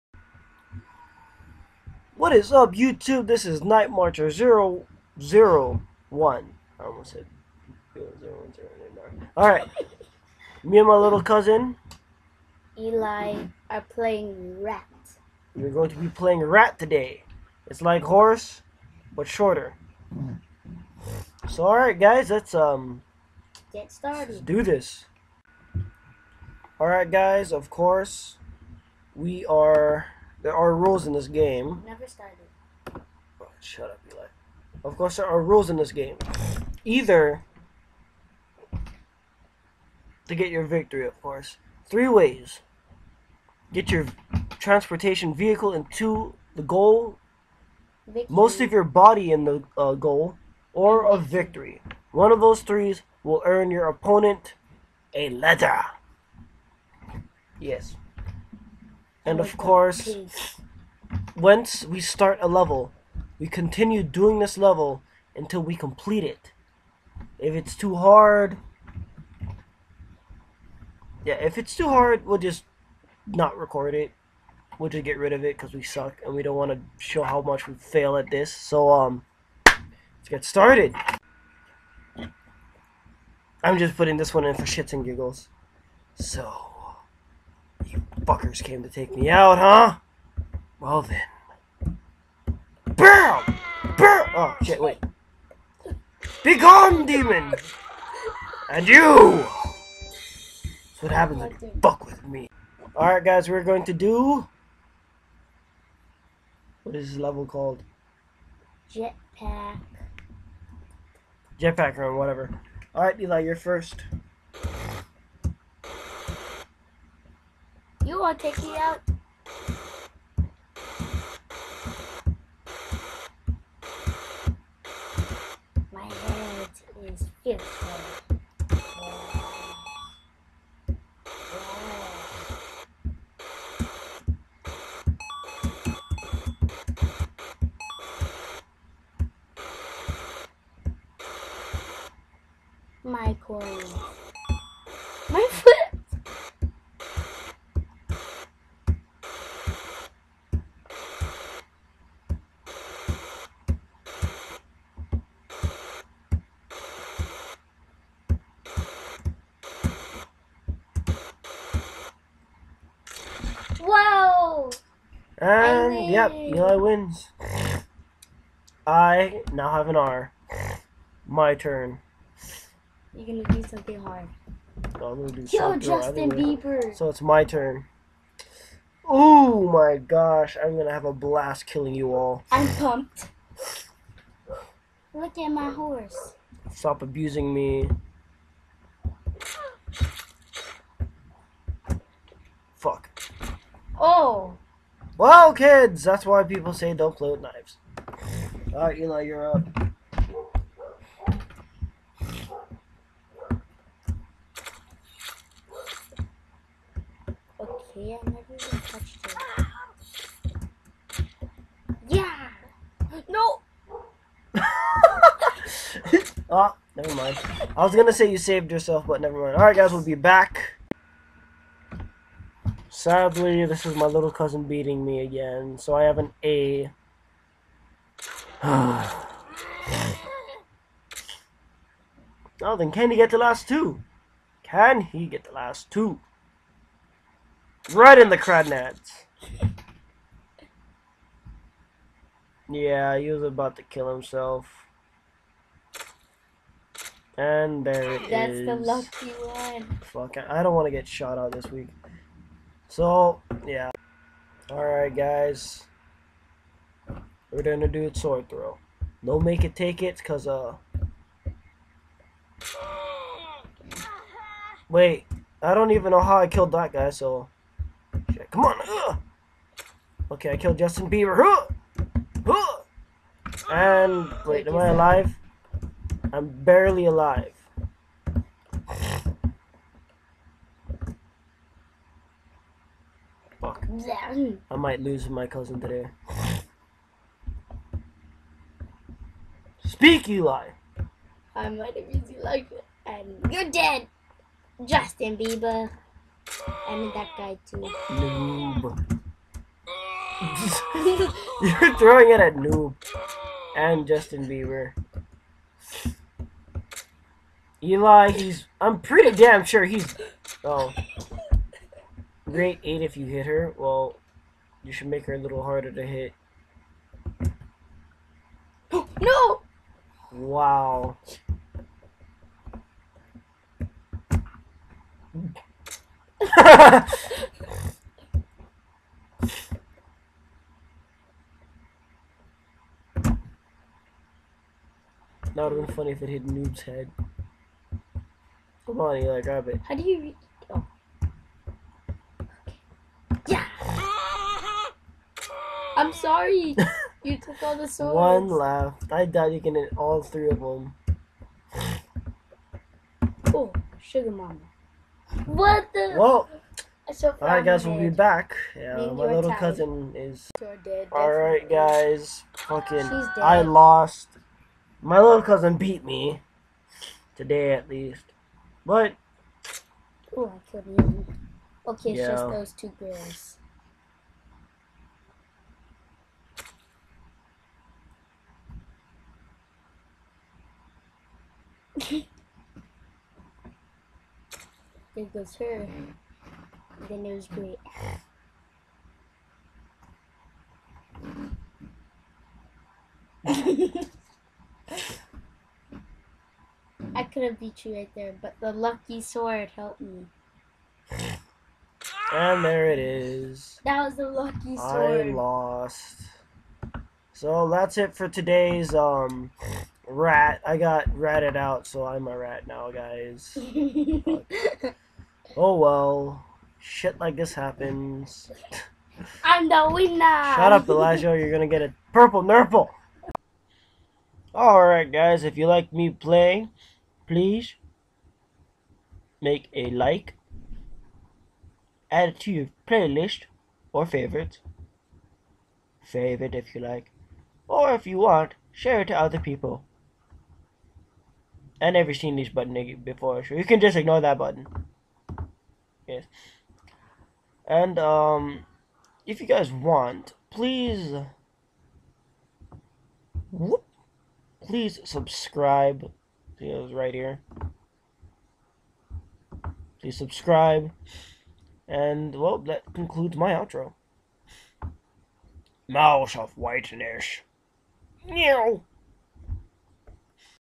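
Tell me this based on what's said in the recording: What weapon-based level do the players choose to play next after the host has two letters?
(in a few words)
Sword throw.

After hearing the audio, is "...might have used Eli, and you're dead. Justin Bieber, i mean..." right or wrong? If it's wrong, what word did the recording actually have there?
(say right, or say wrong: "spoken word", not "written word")
right.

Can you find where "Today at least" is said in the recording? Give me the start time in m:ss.
6:07.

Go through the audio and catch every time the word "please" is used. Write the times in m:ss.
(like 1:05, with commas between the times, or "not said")
7:07, 7:30, 7:34, 7:40.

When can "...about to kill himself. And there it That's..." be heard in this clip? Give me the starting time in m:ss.
4:03.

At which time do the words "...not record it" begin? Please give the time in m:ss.
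1:13.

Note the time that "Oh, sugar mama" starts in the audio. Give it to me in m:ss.
5:53.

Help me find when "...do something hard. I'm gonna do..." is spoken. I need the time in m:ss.
2:53.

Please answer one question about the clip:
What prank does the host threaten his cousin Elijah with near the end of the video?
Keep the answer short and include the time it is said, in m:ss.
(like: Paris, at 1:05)
A purple nurple, at 7:02.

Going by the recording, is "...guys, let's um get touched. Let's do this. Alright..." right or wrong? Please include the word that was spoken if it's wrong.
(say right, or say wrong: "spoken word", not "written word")
wrong: "started", not "touched".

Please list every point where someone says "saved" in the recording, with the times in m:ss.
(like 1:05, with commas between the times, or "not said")
3:38.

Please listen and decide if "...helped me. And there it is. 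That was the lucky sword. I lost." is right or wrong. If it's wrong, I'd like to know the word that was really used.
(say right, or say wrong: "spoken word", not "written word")
right.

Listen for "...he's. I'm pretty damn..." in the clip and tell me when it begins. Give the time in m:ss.
5:08.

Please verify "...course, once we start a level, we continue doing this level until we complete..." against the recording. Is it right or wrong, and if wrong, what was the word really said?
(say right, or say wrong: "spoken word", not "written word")
right.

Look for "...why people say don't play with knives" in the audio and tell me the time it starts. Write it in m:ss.
3:16.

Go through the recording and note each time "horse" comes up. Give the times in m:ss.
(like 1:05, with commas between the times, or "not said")
0:18, 3:05.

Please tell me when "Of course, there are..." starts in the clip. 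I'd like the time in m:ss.
0:34.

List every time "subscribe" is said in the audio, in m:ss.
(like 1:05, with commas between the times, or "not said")
7:35, 7:40.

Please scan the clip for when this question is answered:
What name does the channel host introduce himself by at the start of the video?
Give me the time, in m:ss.
0:03.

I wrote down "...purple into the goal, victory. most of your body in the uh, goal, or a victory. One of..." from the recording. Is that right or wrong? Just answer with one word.
wrong.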